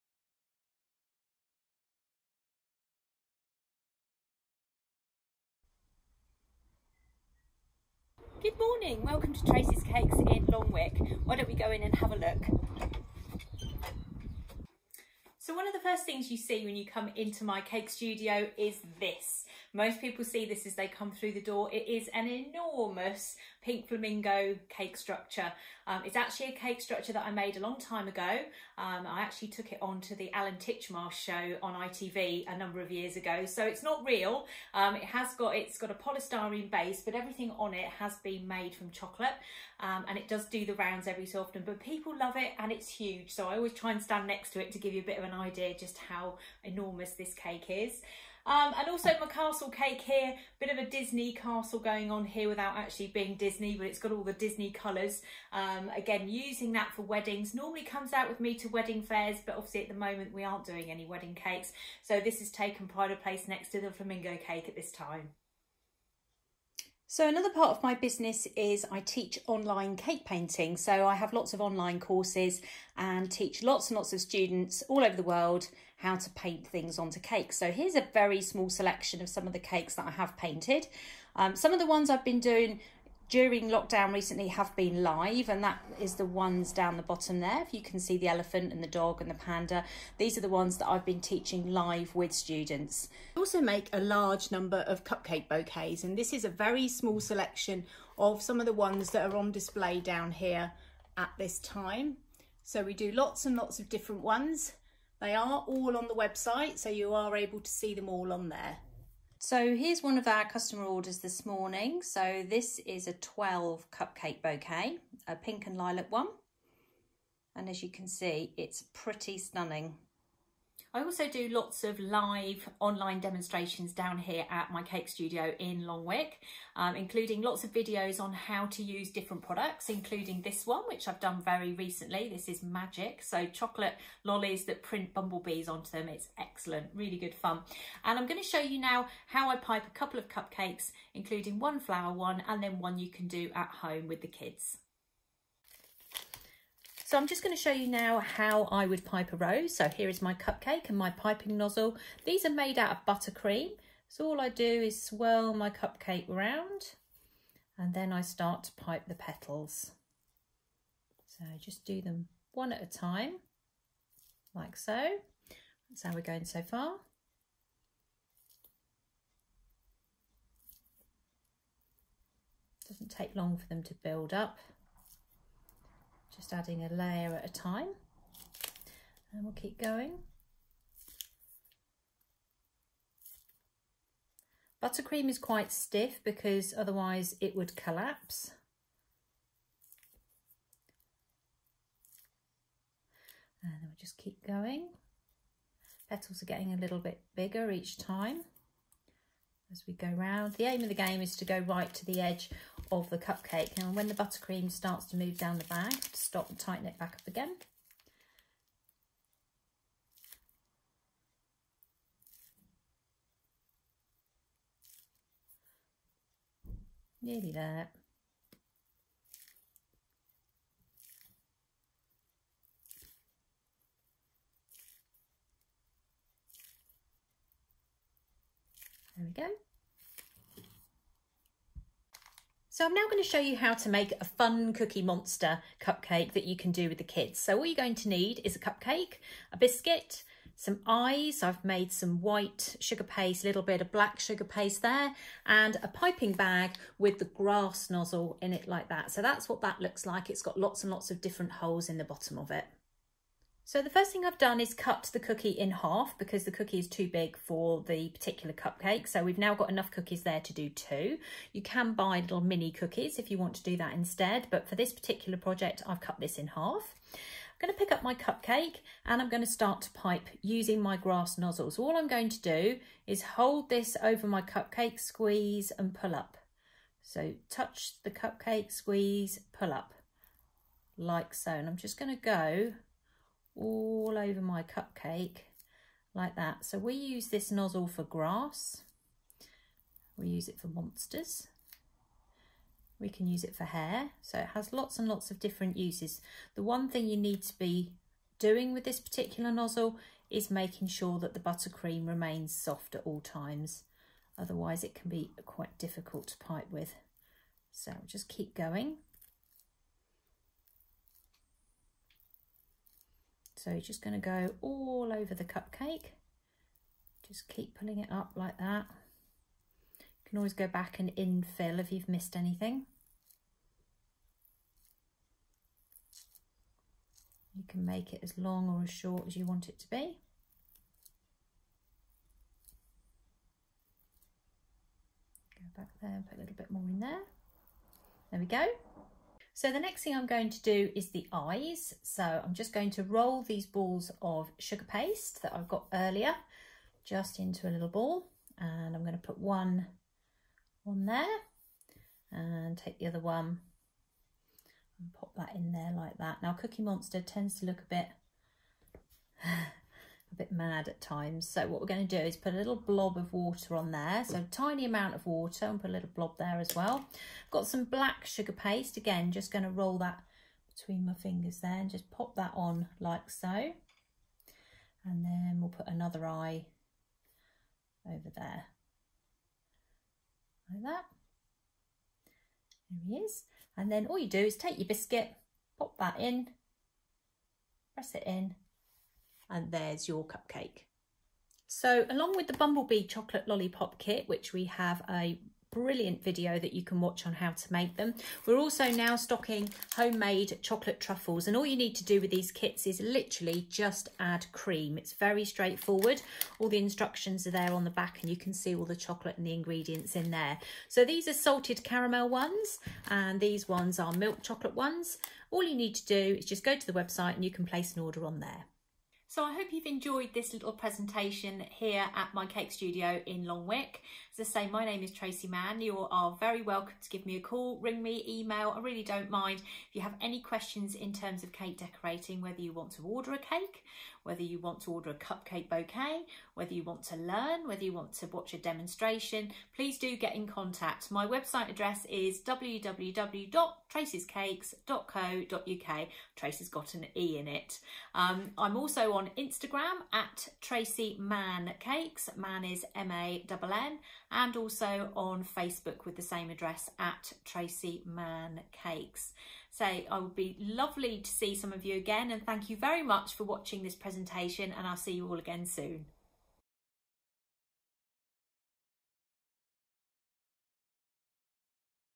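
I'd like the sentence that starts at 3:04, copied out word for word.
Buttercream is quite stiff because otherwise it would collapse.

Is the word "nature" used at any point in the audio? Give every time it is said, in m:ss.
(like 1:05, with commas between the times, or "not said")
not said.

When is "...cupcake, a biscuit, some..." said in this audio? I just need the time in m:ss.
3:58.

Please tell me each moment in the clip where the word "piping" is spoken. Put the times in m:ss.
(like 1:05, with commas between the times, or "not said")
2:31, 4:05.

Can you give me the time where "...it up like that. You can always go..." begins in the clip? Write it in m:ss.
5:17.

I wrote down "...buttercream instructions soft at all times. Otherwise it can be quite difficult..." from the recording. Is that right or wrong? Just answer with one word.
wrong.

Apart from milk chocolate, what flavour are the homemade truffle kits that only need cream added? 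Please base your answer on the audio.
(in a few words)
Salted caramel.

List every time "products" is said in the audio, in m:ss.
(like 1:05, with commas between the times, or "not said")
2:09.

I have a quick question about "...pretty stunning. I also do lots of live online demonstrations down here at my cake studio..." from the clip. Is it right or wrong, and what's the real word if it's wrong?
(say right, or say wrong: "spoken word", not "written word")
right.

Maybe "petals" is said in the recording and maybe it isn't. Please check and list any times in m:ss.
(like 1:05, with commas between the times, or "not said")
2:39, 3:16.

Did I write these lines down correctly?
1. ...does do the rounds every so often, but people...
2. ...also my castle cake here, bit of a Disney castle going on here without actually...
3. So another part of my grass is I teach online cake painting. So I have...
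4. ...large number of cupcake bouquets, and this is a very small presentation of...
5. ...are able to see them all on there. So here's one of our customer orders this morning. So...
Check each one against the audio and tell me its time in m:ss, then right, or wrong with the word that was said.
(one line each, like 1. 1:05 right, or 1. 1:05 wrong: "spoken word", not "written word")
1. 0:40 right
2. 0:48 right
3. 1:07 wrong: "business", not "grass"
4. 1:34 wrong: "selection", not "presentation"
5. 1:47 right.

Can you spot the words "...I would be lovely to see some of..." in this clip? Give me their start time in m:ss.
7:39.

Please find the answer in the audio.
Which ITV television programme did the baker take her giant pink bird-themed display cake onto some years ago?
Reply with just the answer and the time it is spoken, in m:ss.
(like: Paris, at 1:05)
The Alan Titchmarsh Show, at 0:30.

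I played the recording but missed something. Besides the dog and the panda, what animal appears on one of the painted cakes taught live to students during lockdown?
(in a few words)
Elephant.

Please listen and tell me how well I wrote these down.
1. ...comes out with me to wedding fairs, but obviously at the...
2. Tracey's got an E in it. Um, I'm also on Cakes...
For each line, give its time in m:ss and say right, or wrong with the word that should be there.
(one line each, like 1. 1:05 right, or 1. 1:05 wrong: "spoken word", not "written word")
1. 0:57 right
2. 7:26 wrong: "Instagram", not "Cakes".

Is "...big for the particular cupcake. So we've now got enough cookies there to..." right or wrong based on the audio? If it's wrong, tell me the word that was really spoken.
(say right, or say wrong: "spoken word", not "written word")
right.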